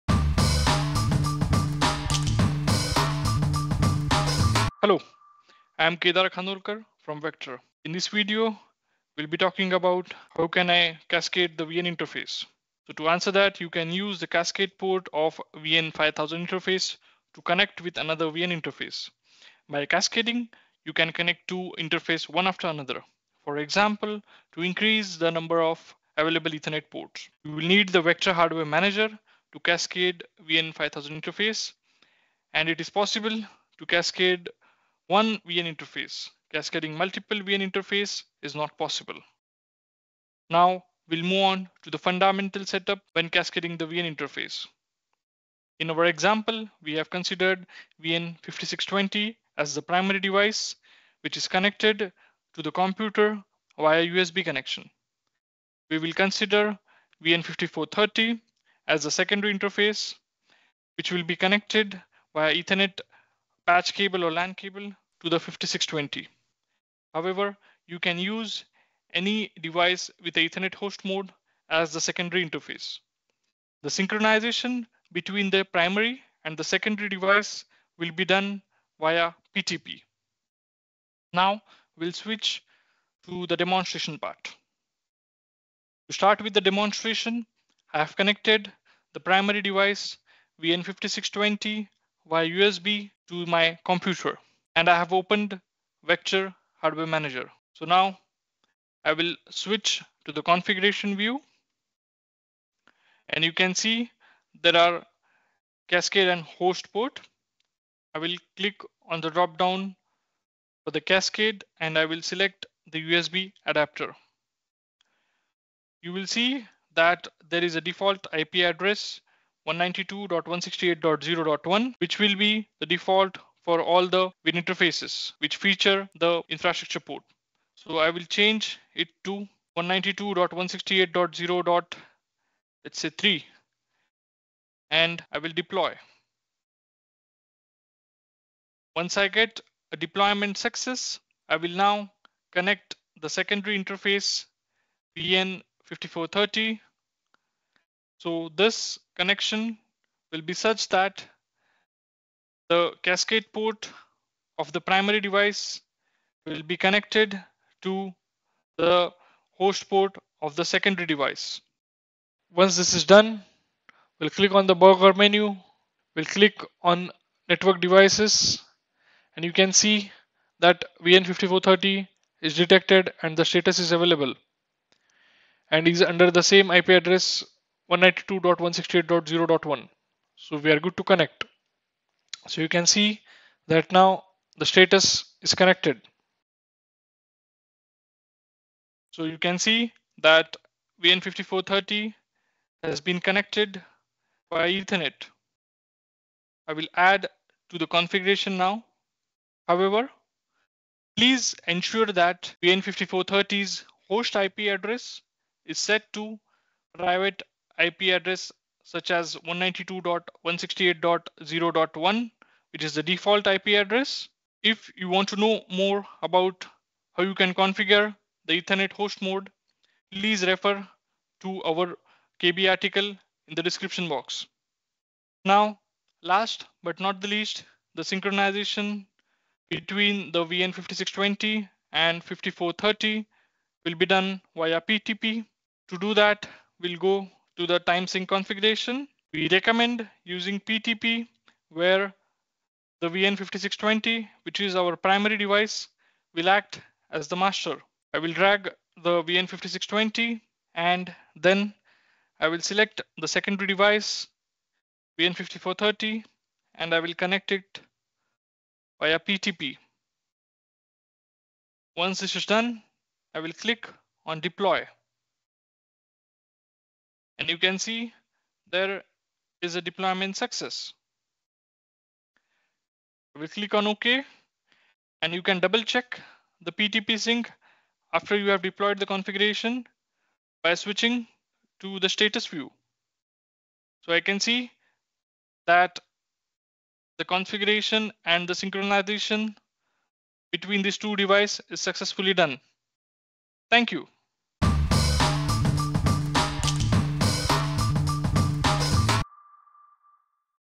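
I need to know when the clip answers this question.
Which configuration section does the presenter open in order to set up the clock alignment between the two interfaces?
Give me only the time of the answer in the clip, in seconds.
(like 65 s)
237 s.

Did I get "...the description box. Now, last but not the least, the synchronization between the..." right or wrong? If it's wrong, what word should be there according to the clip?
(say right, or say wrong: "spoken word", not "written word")
right.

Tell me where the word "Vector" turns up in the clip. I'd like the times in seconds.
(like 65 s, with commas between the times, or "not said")
7 s, 28 s, 96 s.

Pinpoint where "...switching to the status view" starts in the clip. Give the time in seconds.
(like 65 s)
280 s.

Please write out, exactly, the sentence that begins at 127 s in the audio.
So I will change it to 192.168.0.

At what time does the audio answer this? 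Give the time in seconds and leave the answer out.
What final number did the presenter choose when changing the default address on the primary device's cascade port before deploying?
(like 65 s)
133 s.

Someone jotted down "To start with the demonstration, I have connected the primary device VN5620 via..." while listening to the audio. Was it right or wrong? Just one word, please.
right.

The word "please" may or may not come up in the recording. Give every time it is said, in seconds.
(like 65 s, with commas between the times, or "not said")
201 s, 220 s.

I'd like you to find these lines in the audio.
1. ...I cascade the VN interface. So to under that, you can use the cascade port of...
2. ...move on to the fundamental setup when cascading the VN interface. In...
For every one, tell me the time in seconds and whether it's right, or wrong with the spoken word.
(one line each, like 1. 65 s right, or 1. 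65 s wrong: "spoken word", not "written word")
1. 10 s wrong: "answer", not "under"
2. 41 s right.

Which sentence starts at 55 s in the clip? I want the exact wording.
We will consider VN5430 as the secondary interface, which will be connected via Ethernet patch cable or LAN cable to the 5620.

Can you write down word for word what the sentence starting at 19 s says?
By cascading, you can connect two interface one after another.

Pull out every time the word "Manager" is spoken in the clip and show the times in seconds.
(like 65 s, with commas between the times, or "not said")
28 s, 97 s.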